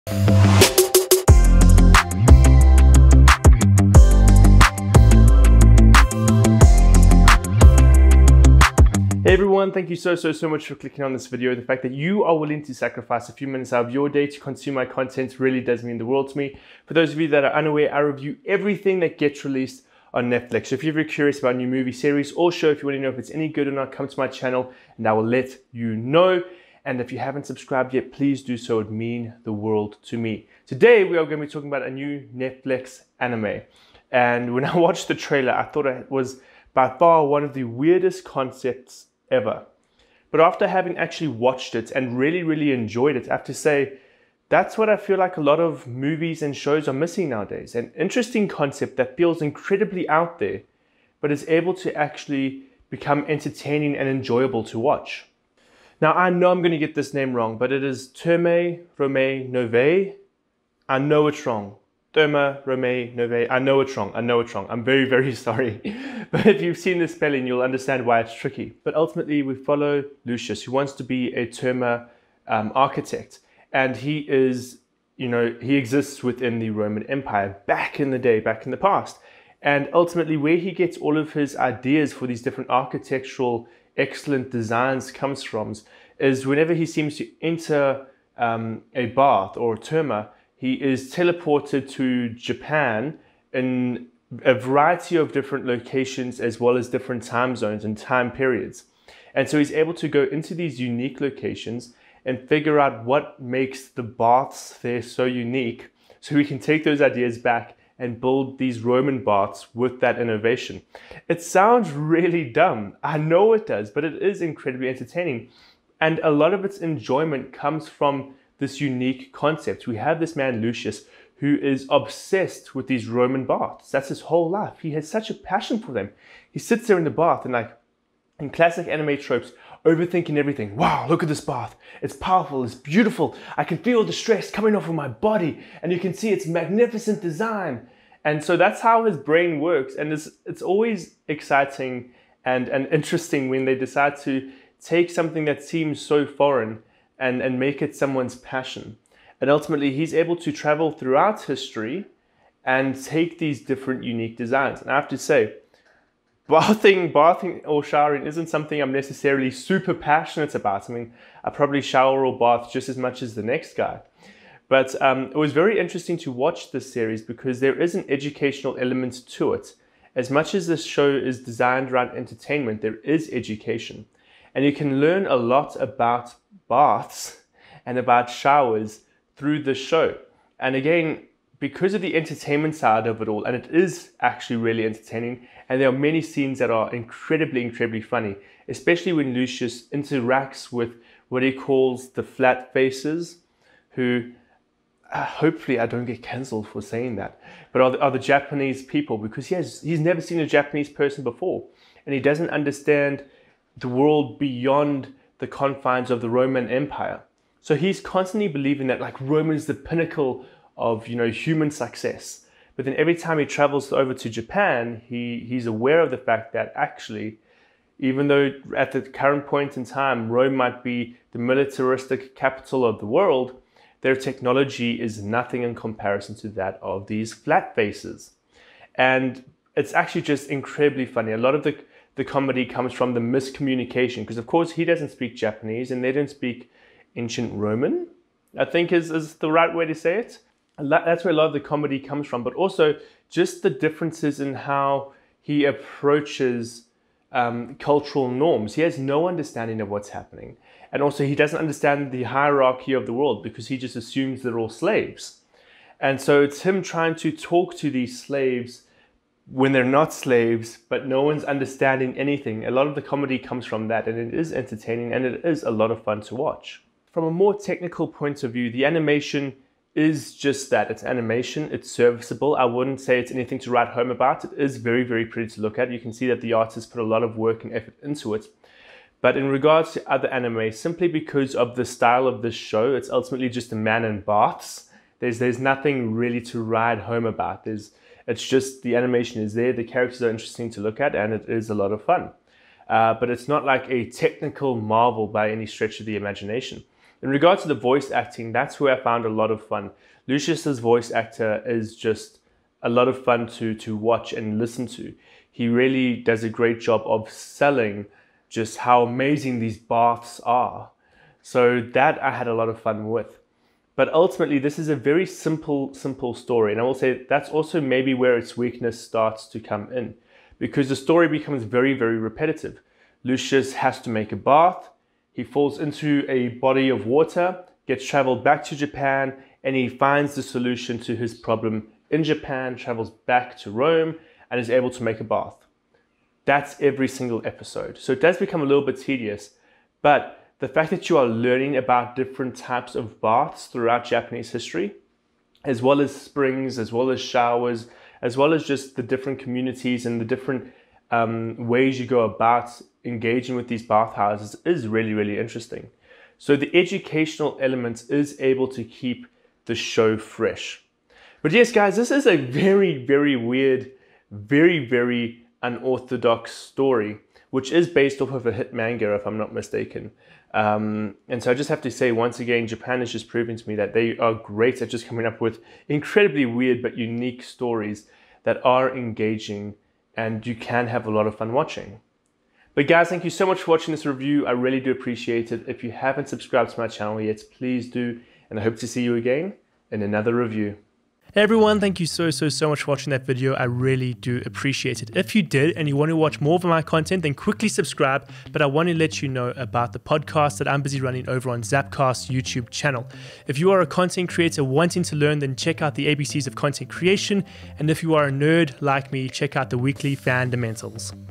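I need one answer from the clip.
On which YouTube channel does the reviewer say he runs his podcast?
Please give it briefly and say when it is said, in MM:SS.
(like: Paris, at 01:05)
Zapcast, at 06:41.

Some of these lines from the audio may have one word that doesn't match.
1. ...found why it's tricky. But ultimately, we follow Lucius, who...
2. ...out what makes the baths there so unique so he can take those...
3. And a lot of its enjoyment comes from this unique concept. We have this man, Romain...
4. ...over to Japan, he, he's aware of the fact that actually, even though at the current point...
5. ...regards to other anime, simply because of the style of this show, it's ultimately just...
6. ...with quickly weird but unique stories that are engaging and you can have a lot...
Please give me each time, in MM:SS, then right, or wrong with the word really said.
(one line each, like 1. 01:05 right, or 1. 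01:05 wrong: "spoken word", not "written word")
1. 01:07 wrong: "understand", not "found"
2. 01:42 right
3. 01:55 wrong: "Lucius", not "Romain"
4. 03:33 right
5. 04:39 right
6. 06:15 wrong: "incredibly", not "quickly".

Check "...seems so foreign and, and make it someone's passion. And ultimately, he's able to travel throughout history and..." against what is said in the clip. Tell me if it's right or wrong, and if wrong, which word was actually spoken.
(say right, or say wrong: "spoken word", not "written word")
right.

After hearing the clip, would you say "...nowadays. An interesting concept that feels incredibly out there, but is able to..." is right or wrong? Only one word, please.
right.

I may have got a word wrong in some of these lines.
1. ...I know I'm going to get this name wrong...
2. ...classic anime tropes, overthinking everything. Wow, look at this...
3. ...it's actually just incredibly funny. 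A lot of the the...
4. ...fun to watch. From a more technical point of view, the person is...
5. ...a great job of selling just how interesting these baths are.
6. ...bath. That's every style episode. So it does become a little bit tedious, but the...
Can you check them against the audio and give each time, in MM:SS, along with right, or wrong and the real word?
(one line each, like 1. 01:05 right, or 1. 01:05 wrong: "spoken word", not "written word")
1. 00:56 right
2. 02:08 right
3. 03:49 right
4. 04:26 wrong: "animation", not "person"
5. 05:06 wrong: "amazing", not "interesting"
6. 05:35 wrong: "single", not "style".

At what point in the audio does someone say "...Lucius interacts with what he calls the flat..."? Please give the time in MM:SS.
03:09.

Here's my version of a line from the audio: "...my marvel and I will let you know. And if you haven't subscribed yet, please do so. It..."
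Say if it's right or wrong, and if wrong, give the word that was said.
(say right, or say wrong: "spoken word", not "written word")
wrong: "channel", not "marvel".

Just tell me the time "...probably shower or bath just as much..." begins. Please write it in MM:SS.
02:41.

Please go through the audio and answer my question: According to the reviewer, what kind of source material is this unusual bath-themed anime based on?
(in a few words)
a hit manga.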